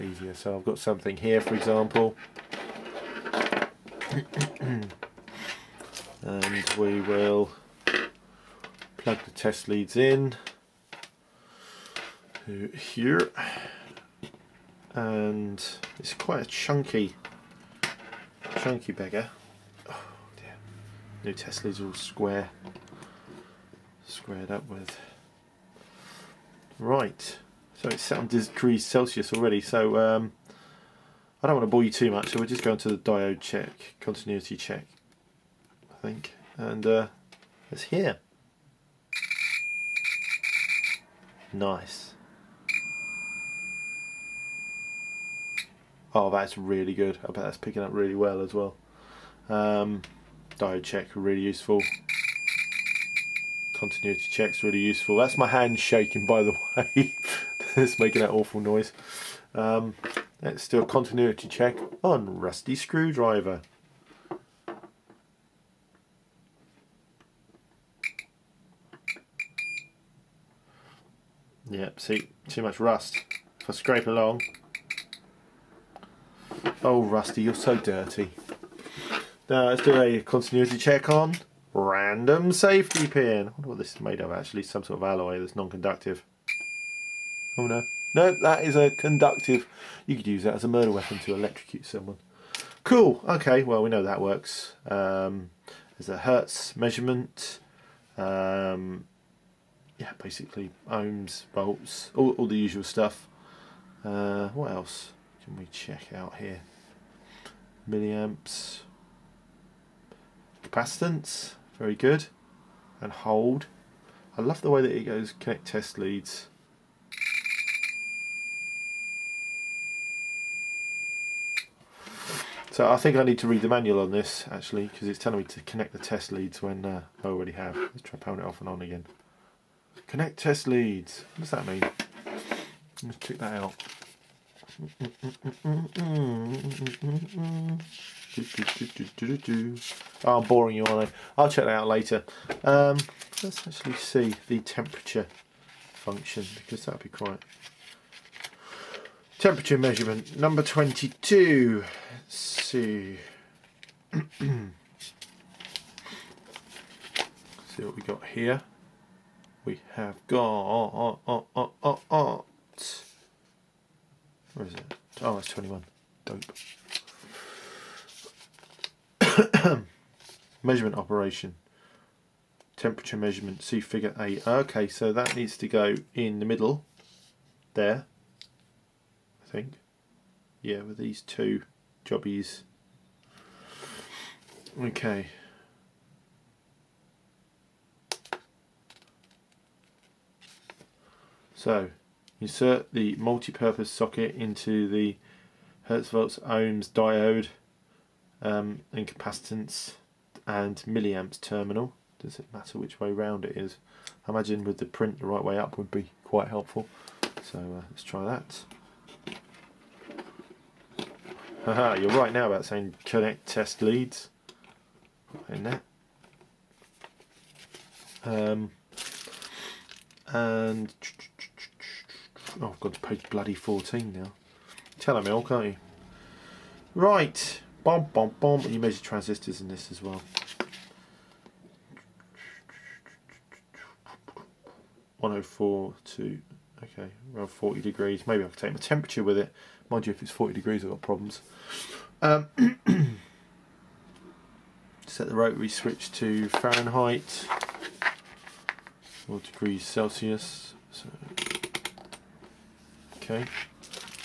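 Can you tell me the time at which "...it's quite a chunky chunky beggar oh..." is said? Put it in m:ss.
0:15.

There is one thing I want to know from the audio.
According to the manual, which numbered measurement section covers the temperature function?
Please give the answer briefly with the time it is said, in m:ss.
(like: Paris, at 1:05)
21, at 2:45.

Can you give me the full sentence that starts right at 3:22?
Does it matter which way round it is?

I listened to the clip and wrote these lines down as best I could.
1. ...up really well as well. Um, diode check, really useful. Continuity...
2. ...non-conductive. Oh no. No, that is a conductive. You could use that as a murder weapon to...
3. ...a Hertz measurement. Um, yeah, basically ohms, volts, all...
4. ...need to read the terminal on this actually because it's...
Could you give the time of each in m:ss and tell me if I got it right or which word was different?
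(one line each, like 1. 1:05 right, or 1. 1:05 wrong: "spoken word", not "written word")
1. 0:47 right
2. 1:25 right
3. 1:36 right
4. 2:03 wrong: "manual", not "terminal".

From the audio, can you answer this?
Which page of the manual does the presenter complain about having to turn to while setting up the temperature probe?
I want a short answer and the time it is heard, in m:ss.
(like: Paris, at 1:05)
14, at 3:42.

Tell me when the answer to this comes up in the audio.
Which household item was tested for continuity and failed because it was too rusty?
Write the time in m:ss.
1:02.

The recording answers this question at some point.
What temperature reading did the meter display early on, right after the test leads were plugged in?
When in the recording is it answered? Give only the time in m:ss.
0:28.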